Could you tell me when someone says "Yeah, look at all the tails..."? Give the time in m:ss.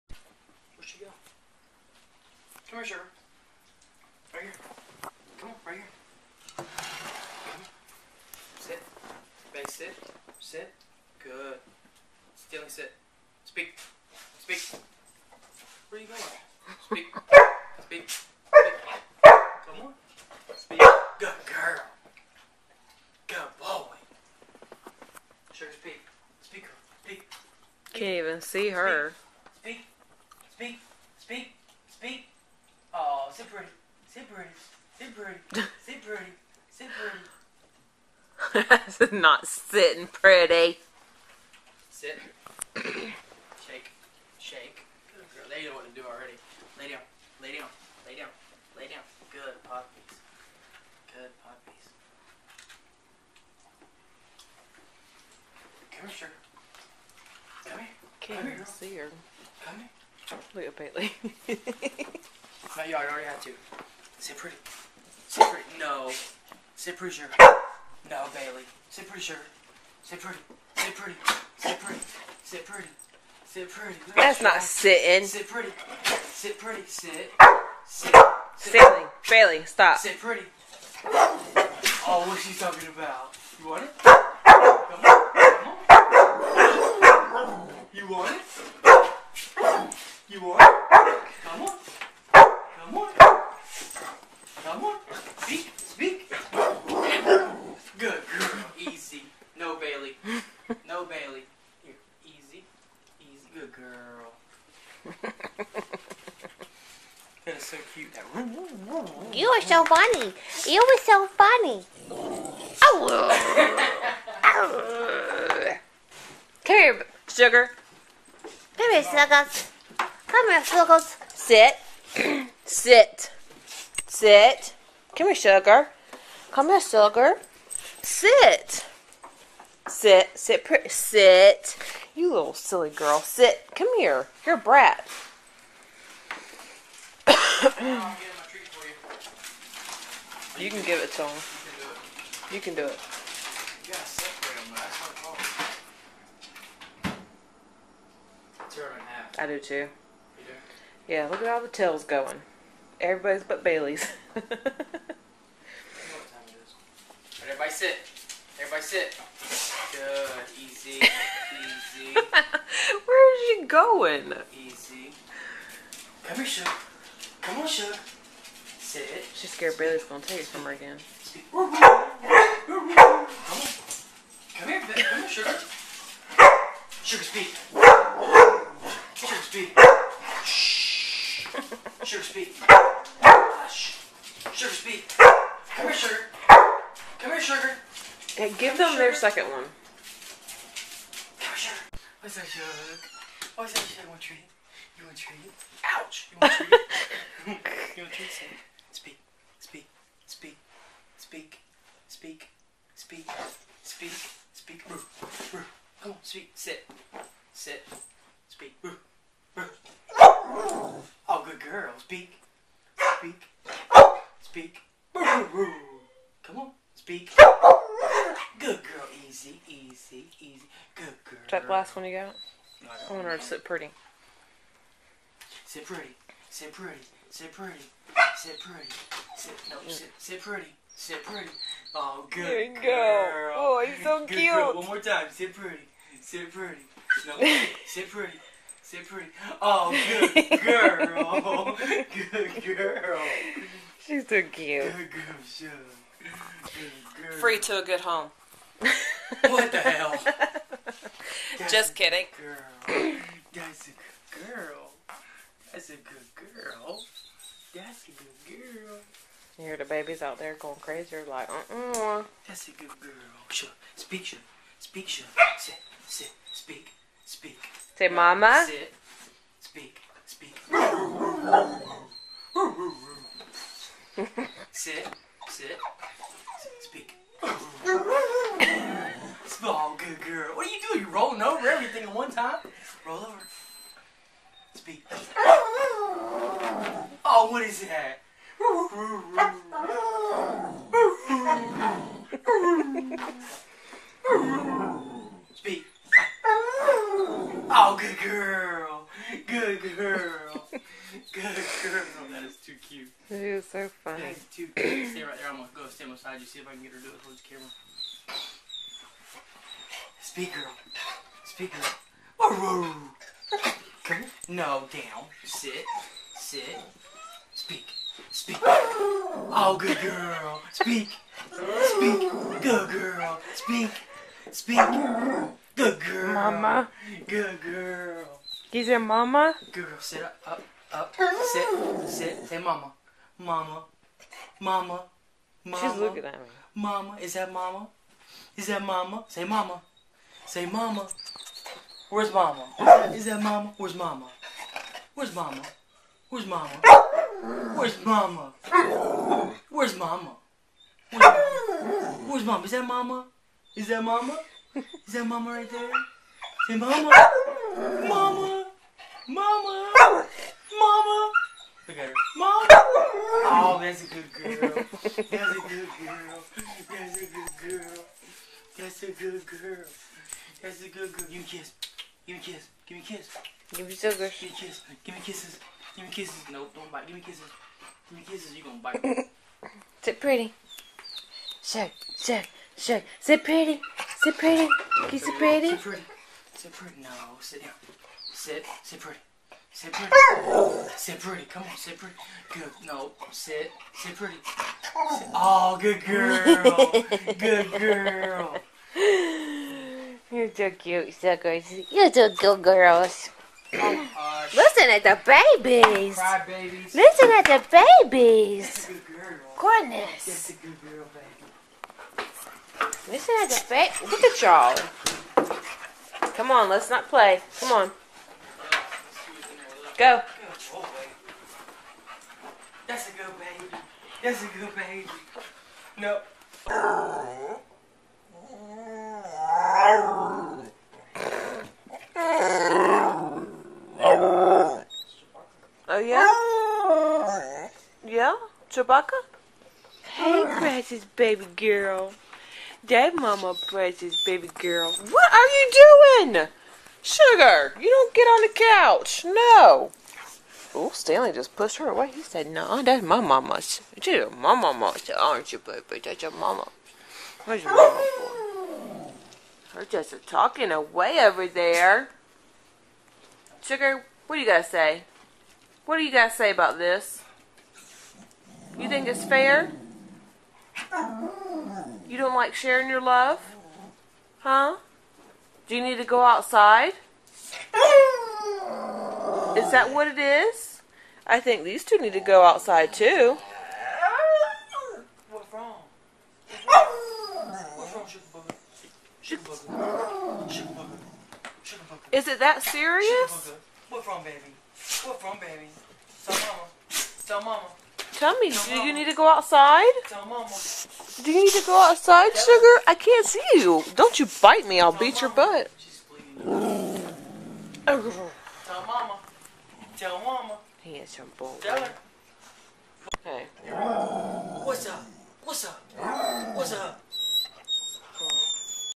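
2:31.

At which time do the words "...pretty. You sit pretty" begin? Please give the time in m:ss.
6:24.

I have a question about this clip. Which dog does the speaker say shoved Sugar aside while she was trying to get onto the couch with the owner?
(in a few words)
Stanley.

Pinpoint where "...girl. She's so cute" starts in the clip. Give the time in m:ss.
4:02.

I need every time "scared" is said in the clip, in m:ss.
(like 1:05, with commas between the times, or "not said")
2:49.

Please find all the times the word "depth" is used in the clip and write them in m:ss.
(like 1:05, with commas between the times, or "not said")
not said.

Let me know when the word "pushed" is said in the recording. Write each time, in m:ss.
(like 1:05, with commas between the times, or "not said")
7:31.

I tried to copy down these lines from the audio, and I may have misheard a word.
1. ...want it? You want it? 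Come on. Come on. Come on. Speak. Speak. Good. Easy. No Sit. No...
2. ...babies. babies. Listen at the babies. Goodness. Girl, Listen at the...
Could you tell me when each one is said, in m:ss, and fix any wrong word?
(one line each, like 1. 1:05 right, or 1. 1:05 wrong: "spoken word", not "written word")
1. 1:28 wrong: "Bailey", not "Sit"
2. 6:45 right.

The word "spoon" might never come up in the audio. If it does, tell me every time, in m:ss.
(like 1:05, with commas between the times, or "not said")
not said.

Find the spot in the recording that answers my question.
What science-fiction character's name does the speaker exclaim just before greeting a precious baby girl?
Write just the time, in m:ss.
7:18.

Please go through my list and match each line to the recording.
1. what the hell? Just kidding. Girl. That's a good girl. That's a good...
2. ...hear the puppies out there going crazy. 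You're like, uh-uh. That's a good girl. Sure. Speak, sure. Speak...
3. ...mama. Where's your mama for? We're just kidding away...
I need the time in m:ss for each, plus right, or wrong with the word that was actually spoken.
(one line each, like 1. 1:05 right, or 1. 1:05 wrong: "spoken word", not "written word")
1. 4:09 right
2. 4:19 wrong: "babies", not "puppies"
3. 7:36 wrong: "talking", not "kidding".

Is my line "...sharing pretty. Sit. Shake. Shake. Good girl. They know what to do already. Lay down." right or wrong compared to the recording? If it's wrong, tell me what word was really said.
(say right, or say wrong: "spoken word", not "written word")
wrong: "sitting", not "sharing".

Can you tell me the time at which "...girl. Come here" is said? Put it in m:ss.
5:11.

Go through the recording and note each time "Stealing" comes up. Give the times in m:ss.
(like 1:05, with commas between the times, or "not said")
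0:12.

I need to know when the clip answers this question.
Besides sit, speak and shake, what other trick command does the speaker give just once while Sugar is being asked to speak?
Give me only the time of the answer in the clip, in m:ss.
4:43.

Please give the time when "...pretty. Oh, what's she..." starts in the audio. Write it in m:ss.
1:20.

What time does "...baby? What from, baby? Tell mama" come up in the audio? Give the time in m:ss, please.
8:14.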